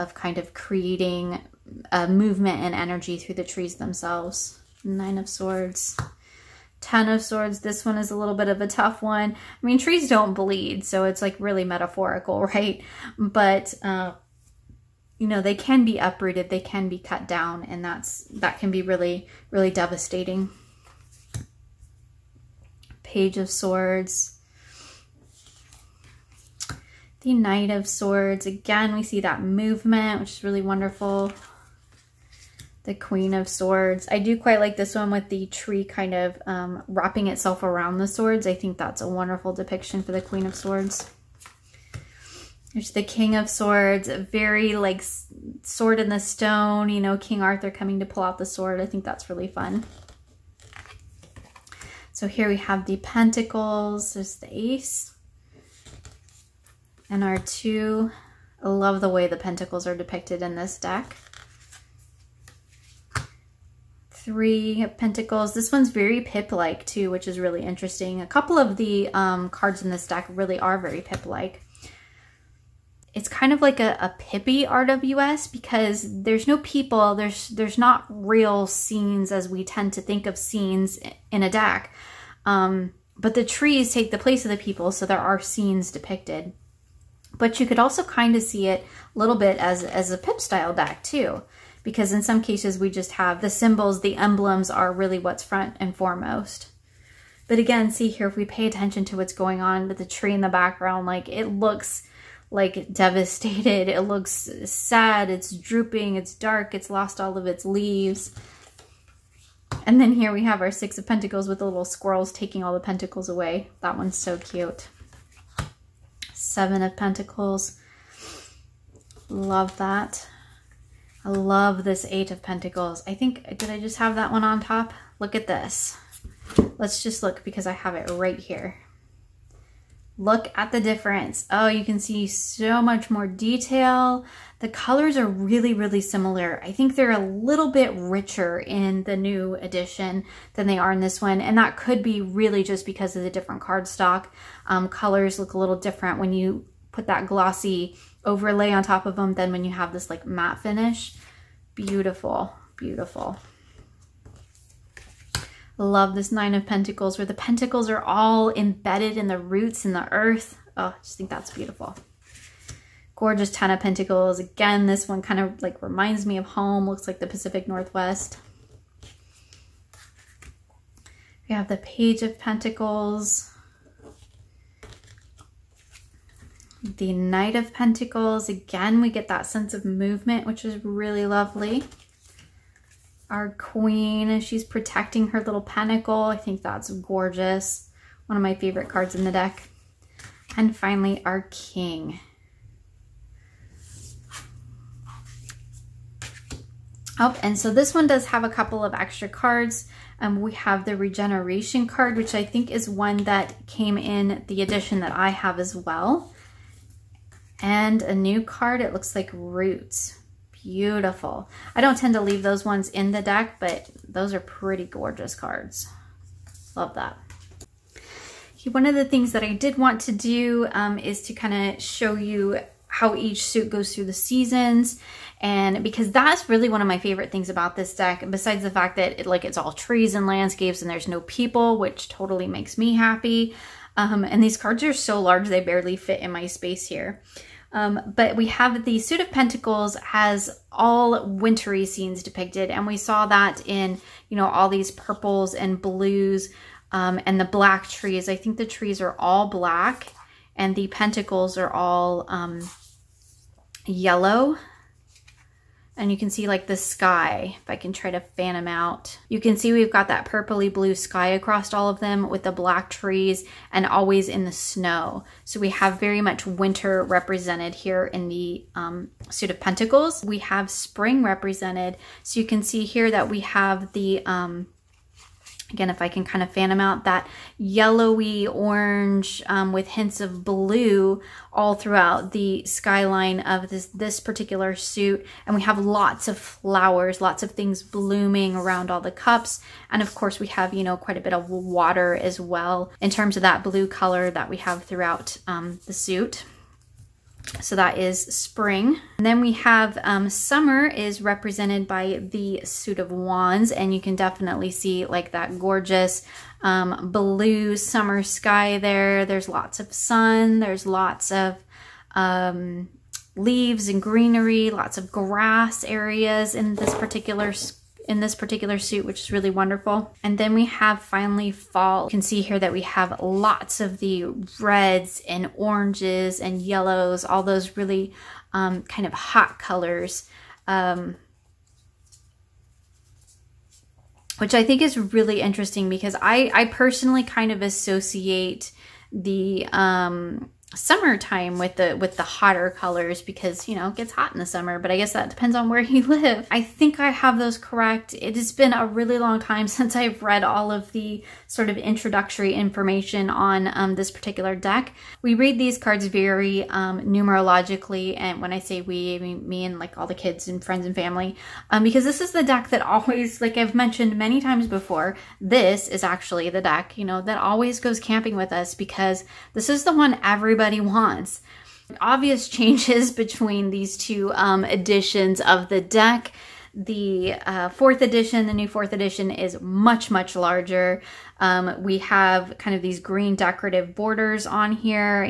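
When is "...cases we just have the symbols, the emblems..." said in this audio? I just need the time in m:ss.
1:32.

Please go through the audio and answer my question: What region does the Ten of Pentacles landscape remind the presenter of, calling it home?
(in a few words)
Pacific Northwest.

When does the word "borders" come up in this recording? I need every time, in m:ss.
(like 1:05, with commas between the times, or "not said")
6:23.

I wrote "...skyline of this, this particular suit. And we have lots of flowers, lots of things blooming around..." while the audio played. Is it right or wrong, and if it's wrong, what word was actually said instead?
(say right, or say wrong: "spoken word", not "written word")
right.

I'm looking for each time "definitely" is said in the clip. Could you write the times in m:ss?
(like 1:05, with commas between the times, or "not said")
5:04.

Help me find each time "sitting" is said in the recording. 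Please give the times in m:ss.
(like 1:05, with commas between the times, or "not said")
not said.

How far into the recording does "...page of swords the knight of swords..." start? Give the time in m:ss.
0:23.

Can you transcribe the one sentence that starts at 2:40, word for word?
Oh, I just think that's beautiful.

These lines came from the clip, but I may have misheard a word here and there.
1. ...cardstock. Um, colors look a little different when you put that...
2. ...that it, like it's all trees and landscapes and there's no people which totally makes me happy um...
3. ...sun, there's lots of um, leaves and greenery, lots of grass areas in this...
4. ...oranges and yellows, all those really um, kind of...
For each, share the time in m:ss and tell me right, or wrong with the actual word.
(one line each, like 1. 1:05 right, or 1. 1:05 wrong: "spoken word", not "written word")
1. 2:23 right
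2. 3:48 right
3. 5:09 right
4. 5:25 right.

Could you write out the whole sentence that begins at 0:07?
This one is a little bit of a tough one.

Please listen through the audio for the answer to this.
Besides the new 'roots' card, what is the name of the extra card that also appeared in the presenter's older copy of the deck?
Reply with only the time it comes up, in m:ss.
3:20.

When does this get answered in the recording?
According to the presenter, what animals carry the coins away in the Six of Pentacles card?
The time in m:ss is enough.
1:51.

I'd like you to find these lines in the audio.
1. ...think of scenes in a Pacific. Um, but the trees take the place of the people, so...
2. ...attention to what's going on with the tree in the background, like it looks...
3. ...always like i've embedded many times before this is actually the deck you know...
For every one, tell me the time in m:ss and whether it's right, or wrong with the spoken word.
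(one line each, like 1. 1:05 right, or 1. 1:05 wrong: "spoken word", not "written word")
1. 1:20 wrong: "DAC", not "Pacific"
2. 1:38 right
3. 6:02 wrong: "mentioned", not "embedded".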